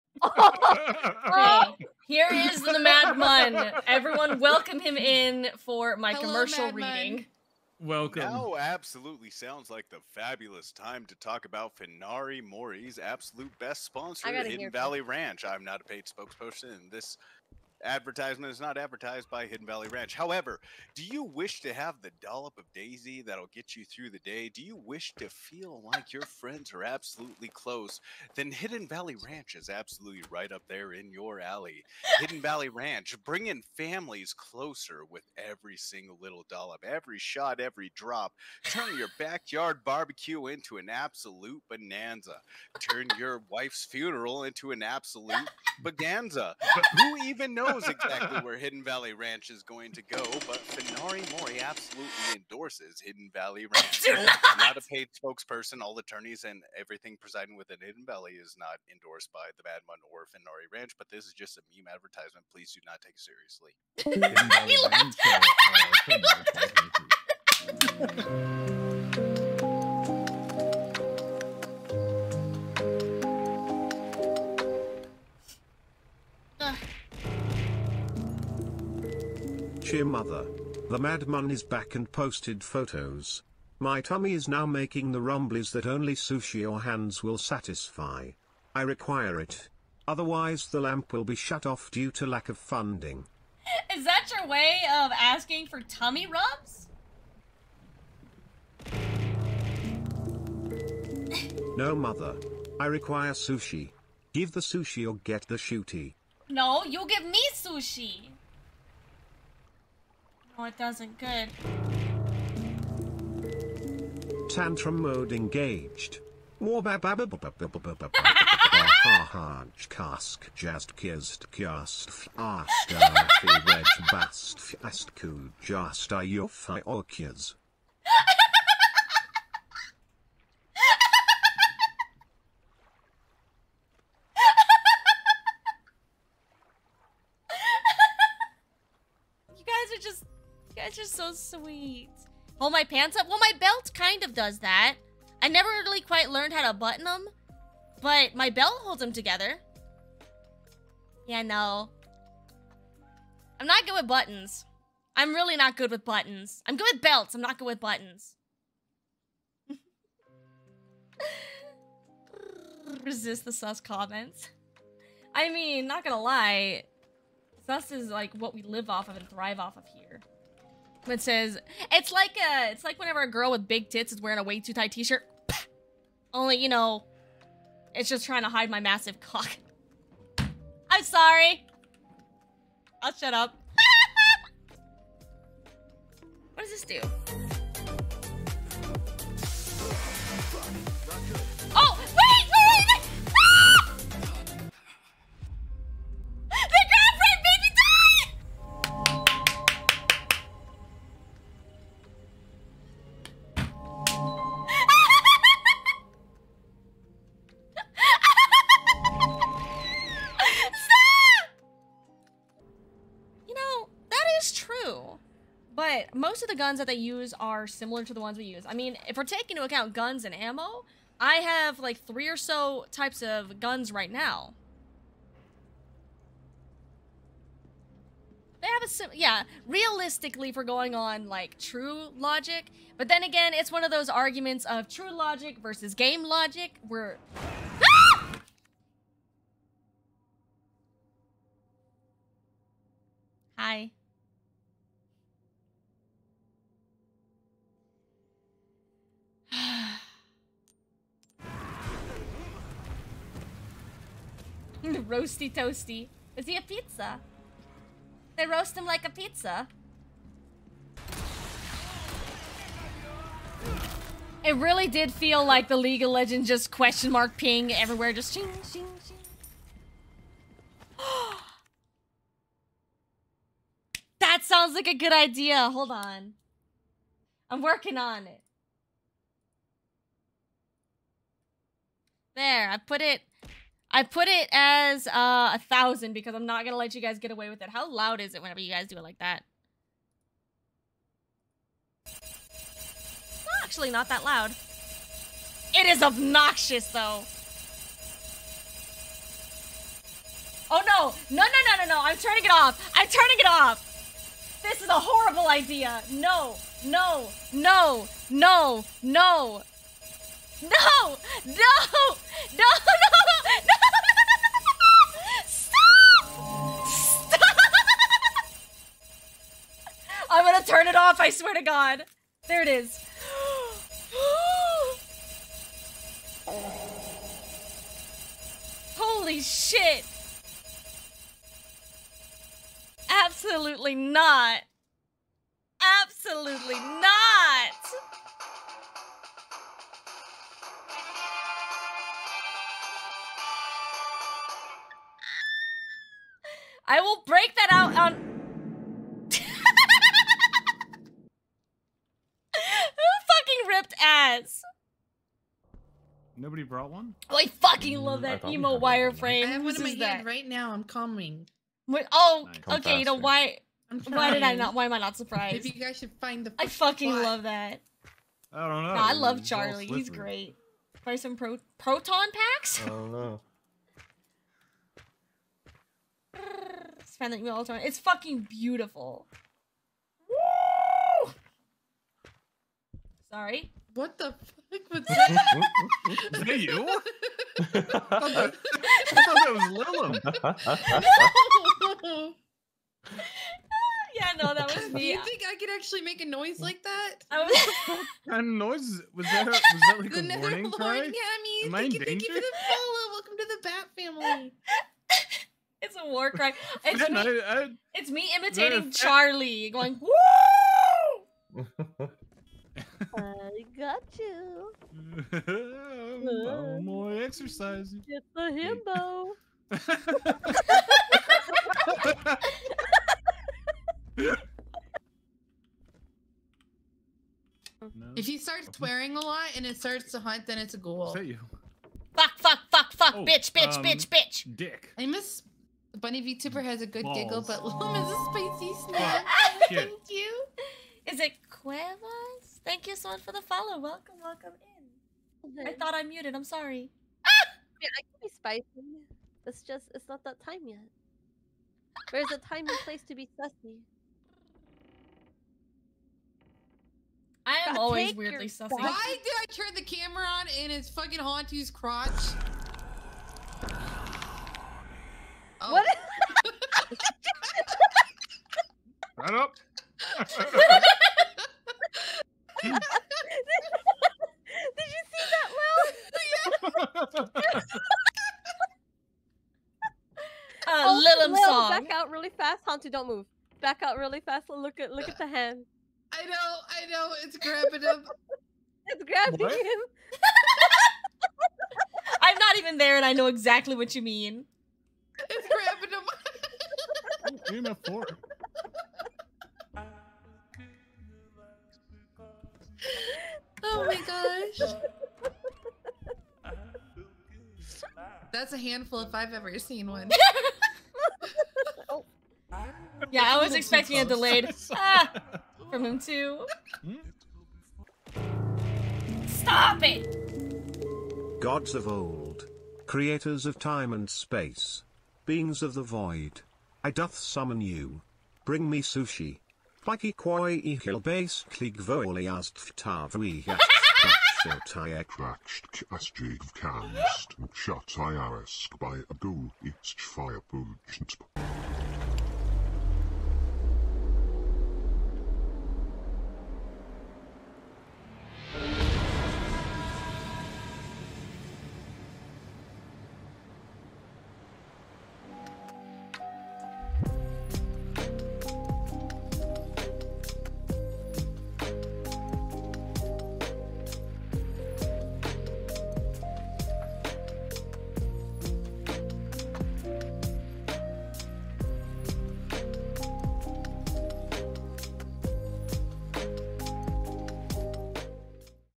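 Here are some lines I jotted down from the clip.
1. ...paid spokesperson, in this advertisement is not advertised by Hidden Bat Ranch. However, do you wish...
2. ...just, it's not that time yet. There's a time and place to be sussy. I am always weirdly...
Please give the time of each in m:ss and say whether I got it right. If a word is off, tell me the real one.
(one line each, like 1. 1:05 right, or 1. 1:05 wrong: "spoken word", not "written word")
1. 0:15 wrong: "Valley", not "Bat"
2. 7:29 right.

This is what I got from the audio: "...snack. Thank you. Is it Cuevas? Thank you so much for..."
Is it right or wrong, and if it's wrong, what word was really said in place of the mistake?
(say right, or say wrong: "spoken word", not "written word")
right.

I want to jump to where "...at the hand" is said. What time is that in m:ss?
8:05.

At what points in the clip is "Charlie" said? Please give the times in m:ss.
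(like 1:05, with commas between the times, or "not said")
6:09, 6:48.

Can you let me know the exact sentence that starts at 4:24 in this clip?
It really did feel like the League of Legends just question mark ping everywhere, just ching, ching, ching.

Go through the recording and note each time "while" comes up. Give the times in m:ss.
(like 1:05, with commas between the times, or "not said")
not said.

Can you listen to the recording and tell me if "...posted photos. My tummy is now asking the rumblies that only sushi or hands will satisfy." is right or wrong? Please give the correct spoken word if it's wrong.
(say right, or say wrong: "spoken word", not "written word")
wrong: "making", not "asking".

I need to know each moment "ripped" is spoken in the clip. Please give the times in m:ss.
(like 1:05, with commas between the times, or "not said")
5:53.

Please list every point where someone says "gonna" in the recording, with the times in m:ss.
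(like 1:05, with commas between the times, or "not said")
2:46, 4:46, 5:20.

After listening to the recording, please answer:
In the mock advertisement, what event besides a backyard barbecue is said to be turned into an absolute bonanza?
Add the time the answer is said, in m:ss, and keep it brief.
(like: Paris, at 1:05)
Wife's funeral, at 0:43.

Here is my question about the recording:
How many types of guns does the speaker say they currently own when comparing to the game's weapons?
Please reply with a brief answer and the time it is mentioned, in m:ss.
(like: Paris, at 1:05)
3, at 3:41.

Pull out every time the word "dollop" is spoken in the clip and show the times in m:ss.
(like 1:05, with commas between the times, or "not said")
0:22, 0:36.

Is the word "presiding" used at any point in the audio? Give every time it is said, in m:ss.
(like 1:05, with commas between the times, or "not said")
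0:57.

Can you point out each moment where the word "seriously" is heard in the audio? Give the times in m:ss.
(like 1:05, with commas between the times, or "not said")
1:03.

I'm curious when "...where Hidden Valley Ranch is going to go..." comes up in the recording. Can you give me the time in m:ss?
0:48.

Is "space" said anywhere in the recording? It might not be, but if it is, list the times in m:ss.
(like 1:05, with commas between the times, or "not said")
8:44.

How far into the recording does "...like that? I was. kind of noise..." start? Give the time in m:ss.
6:36.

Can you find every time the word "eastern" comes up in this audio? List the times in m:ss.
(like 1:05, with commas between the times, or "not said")
not said.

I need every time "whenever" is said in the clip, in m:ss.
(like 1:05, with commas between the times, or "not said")
2:52, 4:48.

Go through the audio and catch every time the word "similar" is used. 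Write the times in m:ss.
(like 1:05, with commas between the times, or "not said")
3:37.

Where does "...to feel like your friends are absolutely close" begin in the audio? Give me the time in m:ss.
0:25.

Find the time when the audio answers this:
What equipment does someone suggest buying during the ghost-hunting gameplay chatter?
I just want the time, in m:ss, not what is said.
6:11.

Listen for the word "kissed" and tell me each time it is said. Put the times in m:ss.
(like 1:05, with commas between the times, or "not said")
2:00.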